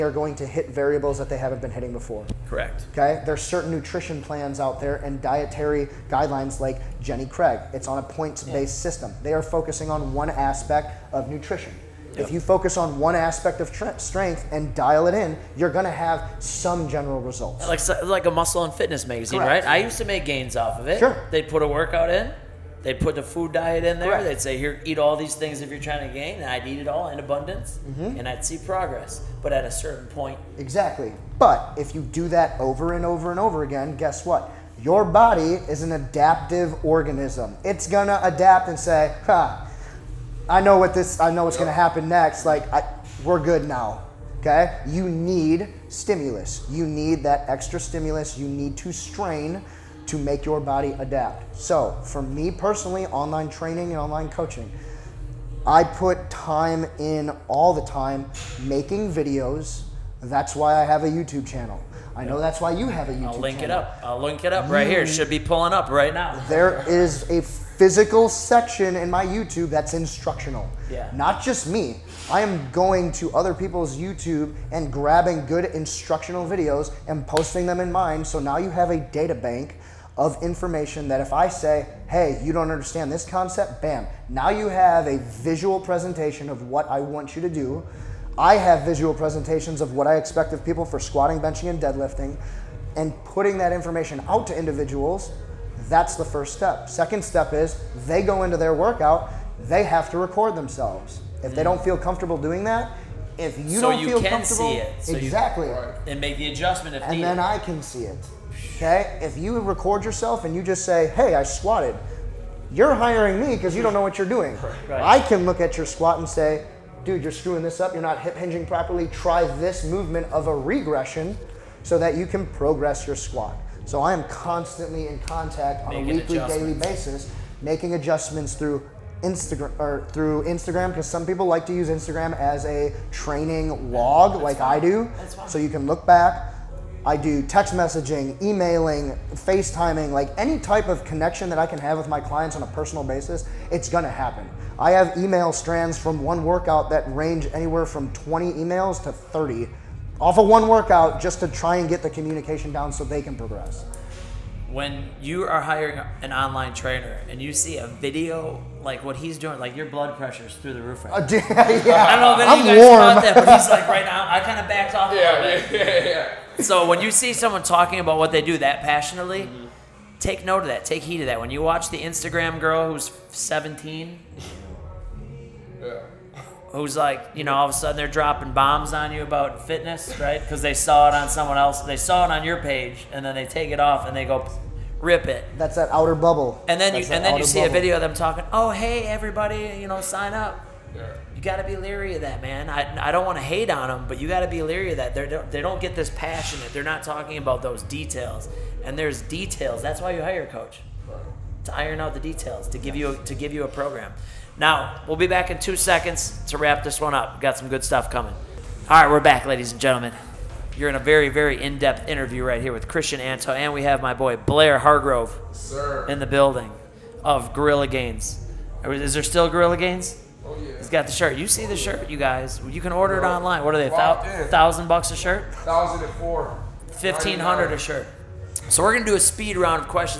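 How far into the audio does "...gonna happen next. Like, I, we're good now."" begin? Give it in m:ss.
0:41.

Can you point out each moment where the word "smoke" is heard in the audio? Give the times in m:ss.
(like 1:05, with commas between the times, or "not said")
not said.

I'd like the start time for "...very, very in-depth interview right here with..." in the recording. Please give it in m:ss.
3:30.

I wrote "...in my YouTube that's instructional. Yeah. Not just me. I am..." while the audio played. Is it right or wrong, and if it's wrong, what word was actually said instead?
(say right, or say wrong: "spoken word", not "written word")
right.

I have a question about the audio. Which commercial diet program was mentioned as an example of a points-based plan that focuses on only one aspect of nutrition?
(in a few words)
Jenny Craig.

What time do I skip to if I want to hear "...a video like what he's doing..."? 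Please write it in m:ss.
2:37.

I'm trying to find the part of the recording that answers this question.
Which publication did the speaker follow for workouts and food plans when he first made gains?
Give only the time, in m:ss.
0:18.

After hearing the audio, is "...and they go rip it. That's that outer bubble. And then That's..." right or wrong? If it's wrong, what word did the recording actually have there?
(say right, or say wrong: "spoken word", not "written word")
right.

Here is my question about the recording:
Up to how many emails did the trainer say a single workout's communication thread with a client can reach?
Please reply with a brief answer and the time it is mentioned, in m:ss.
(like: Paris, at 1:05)
30, at 2:29.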